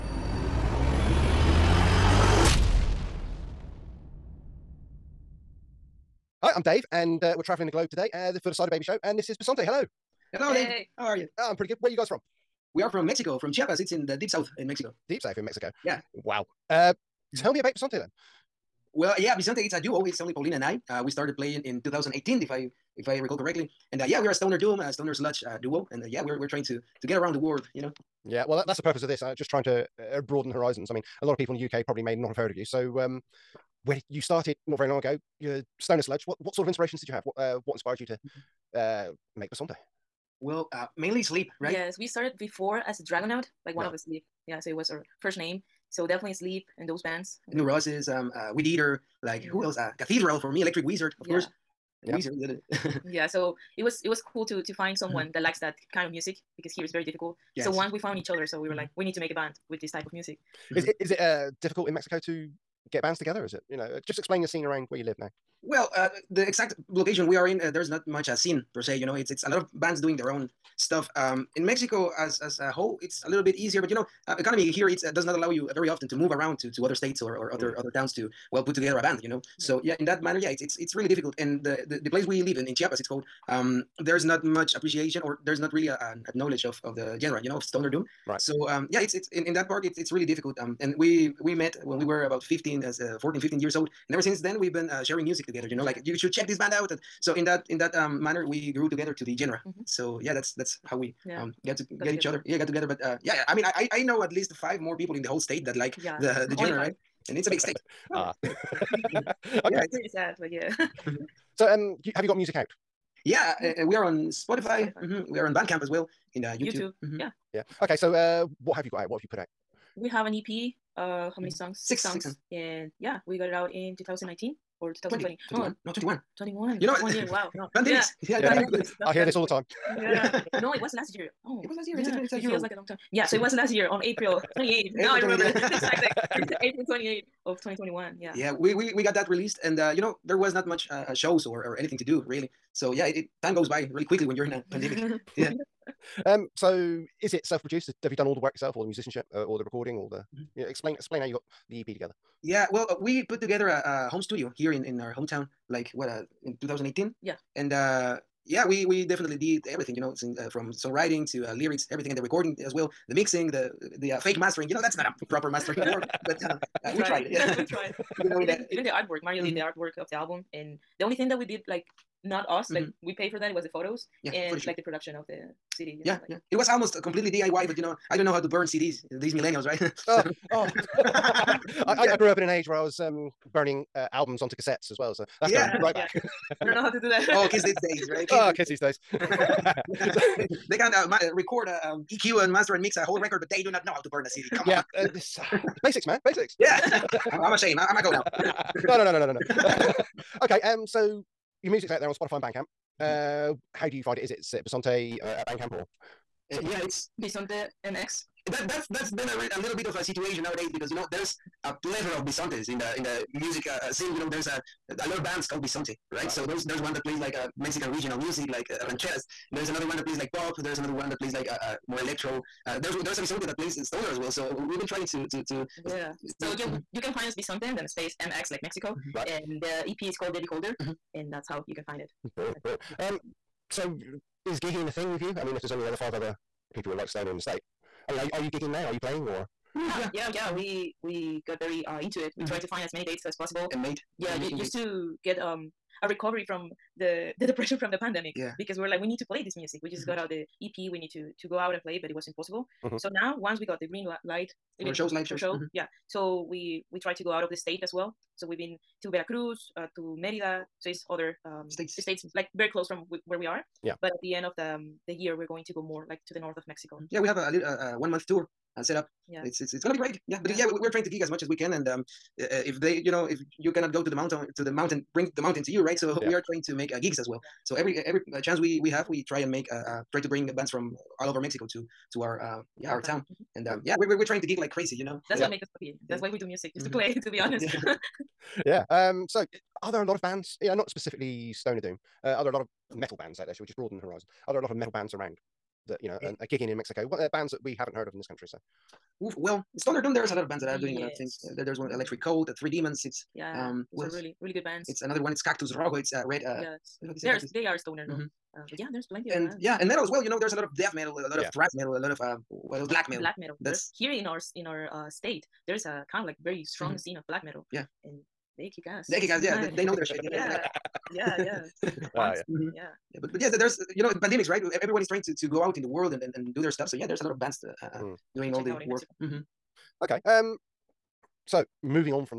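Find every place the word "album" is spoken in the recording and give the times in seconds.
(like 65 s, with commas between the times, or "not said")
170 s, 184 s.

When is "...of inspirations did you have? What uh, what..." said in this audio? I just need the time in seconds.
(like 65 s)
36 s.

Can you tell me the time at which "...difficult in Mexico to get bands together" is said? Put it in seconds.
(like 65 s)
61 s.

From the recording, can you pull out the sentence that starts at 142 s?
So yeah, it, it time goes by really quickly when you're in a pandemic.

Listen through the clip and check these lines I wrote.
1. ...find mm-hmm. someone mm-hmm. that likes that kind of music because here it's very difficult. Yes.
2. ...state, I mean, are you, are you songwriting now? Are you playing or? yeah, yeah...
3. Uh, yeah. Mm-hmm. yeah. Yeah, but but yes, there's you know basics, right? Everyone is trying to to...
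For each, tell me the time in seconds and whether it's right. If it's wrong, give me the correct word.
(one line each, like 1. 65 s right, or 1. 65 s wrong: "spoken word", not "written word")
1. 54 s right
2. 237 s wrong: "gigging", not "songwriting"
3. 321 s wrong: "pandemics", not "basics".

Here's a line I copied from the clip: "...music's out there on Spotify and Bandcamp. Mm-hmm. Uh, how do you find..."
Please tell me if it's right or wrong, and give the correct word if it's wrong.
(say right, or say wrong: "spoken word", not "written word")
right.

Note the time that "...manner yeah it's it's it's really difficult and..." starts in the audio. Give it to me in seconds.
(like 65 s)
80 s.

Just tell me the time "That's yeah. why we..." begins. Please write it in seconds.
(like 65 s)
286 s.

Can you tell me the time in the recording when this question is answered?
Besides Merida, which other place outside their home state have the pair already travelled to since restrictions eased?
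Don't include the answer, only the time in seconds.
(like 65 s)
259 s.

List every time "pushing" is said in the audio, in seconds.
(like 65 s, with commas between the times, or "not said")
not said.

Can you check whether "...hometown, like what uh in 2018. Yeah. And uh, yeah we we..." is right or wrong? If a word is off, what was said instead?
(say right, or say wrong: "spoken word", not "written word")
right.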